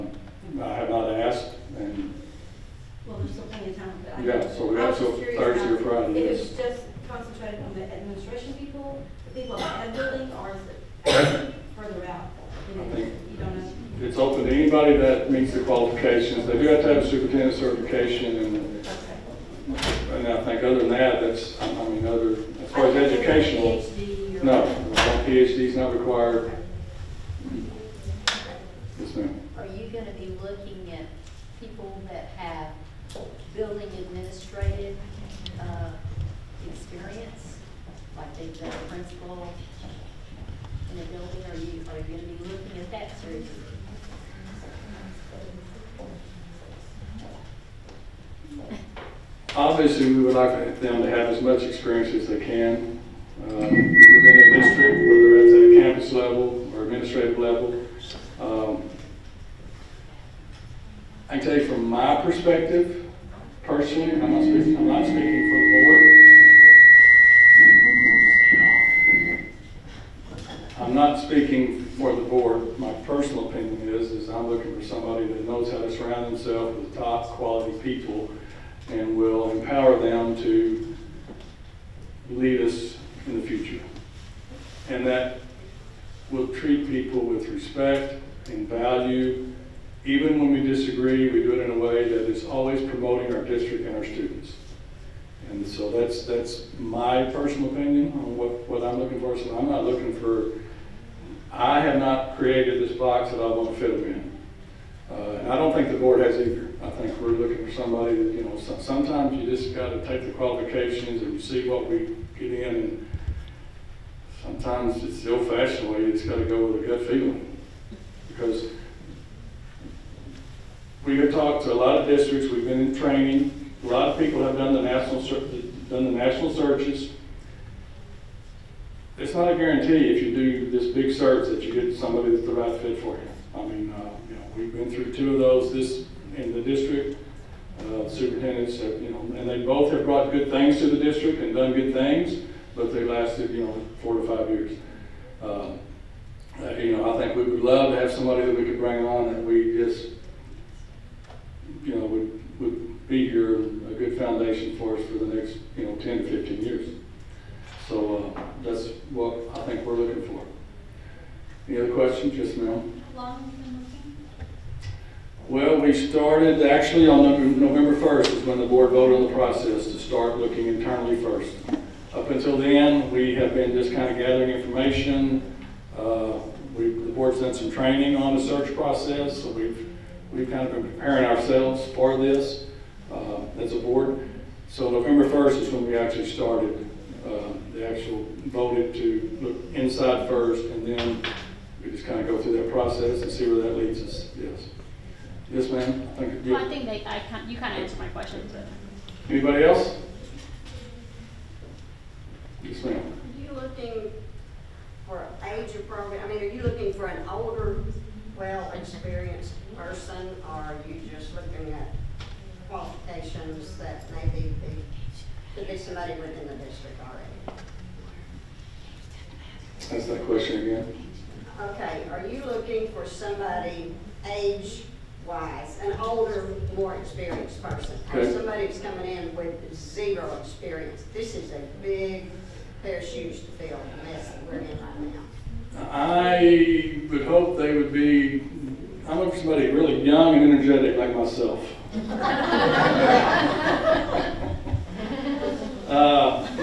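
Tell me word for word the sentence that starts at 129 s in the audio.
It's not a guarantee if you do this big search that you get somebody that's the right fit for you.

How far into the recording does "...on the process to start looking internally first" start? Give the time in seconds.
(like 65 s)
169 s.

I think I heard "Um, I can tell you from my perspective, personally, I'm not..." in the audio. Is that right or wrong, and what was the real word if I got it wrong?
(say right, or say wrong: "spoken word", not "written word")
right.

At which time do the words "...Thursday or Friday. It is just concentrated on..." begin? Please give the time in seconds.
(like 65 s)
5 s.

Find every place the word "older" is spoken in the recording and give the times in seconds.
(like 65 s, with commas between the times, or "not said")
207 s, 225 s.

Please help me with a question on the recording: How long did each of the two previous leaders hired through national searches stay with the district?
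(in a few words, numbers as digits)
4 to 5 years.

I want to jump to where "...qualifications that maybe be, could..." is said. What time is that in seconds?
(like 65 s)
212 s.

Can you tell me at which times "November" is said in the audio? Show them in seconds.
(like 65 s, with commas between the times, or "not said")
167 s, 184 s.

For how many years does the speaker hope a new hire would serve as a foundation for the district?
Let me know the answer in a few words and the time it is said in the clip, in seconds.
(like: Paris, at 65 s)
10 to 15 years, at 155 s.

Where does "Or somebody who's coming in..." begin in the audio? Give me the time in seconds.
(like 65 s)
228 s.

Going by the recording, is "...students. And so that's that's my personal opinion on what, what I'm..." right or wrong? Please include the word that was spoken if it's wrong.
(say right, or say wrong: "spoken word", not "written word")
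right.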